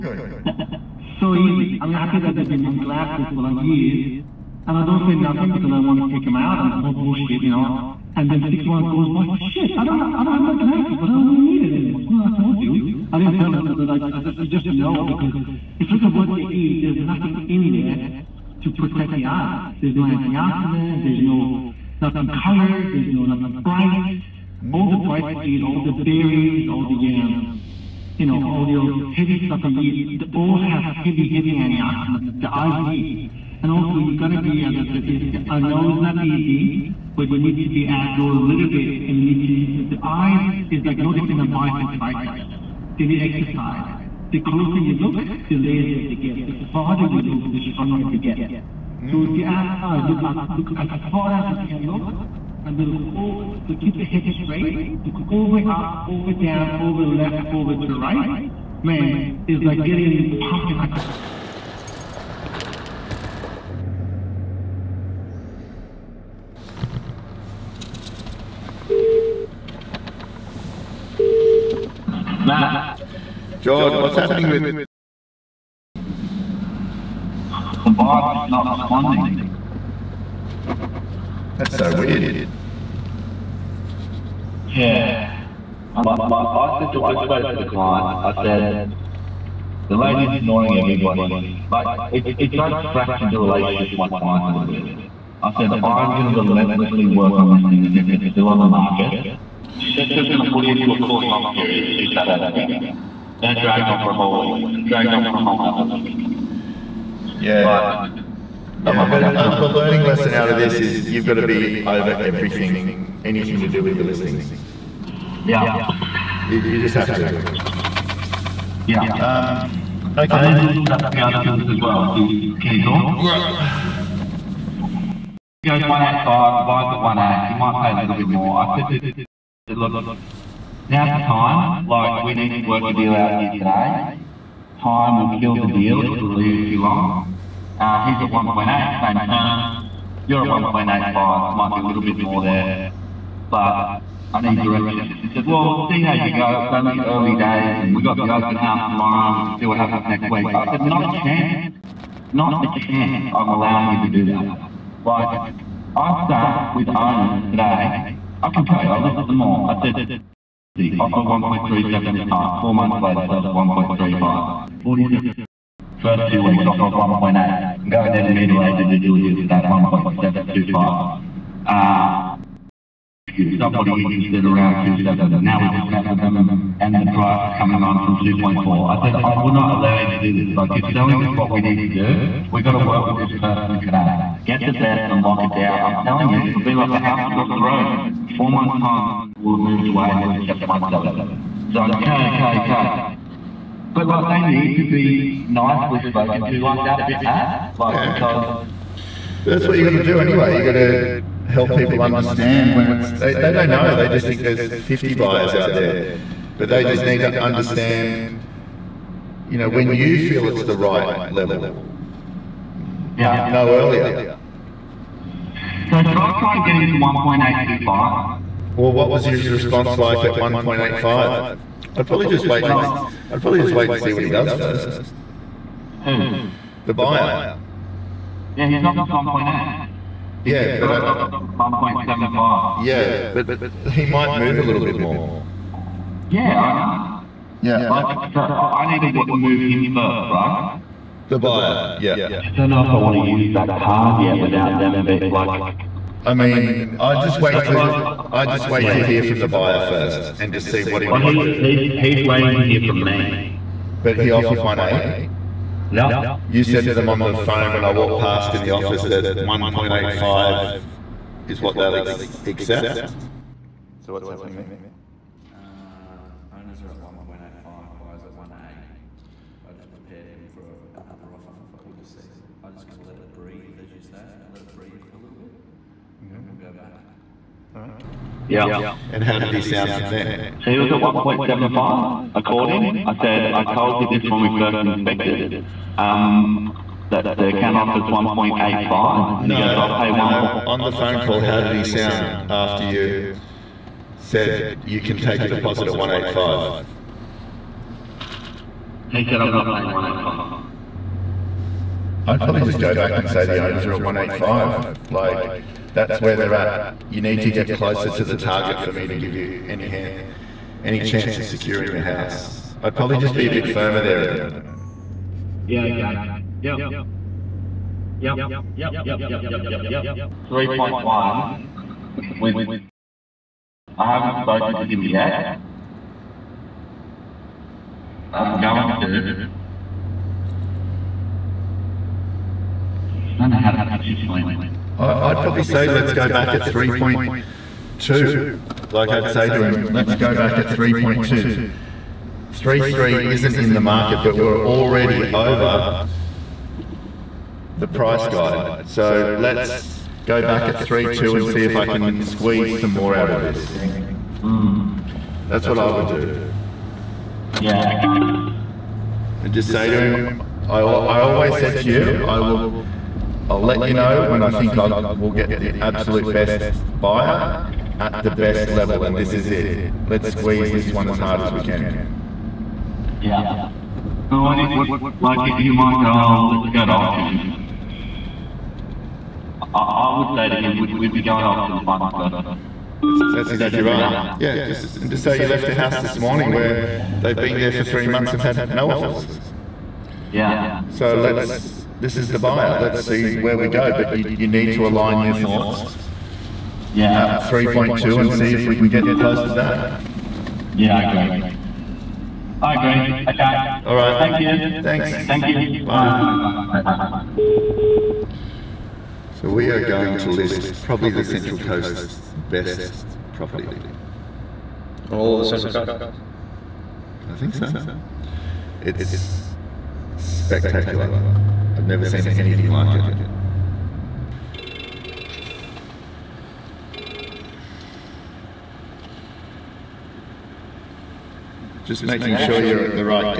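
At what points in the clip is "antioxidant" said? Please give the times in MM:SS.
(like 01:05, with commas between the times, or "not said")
00:20, 00:31.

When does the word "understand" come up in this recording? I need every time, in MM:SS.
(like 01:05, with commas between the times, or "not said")
03:22, 03:27.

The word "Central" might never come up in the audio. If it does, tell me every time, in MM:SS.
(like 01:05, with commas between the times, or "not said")
06:51, 06:55.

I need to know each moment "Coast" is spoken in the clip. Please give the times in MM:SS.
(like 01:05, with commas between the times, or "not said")
06:51, 06:55.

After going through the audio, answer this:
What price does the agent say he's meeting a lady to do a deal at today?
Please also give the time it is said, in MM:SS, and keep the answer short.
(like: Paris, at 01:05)
1.725, at 02:49.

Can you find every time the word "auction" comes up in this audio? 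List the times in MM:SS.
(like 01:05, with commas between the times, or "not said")
06:16, 06:21.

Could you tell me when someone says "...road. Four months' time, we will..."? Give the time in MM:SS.
03:07.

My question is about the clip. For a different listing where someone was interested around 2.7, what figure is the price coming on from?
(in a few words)
2.4.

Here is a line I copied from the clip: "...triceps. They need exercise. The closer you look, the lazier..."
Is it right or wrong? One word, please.
right.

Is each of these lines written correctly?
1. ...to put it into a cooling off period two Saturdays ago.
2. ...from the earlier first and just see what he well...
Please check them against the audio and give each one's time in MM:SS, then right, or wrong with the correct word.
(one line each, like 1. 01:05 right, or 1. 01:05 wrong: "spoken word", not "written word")
1. 01:40 right
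2. 04:09 wrong: "buyer", not "earlier".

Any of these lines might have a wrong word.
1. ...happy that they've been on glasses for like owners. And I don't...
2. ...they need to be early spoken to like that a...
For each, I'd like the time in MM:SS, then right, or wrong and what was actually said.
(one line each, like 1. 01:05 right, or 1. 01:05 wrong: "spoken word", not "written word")
1. 00:01 wrong: "years", not "owners"
2. 03:14 wrong: "nicely", not "early".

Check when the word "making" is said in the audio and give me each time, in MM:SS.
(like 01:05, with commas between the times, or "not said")
07:12.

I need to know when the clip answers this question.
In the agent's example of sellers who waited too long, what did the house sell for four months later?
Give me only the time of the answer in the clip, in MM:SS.
02:43.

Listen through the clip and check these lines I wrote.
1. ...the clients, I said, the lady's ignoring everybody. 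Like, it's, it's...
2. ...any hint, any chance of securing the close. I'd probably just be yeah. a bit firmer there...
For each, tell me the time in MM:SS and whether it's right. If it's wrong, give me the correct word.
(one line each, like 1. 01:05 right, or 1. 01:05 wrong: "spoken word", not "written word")
1. 01:27 right
2. 05:09 wrong: "house", not "close".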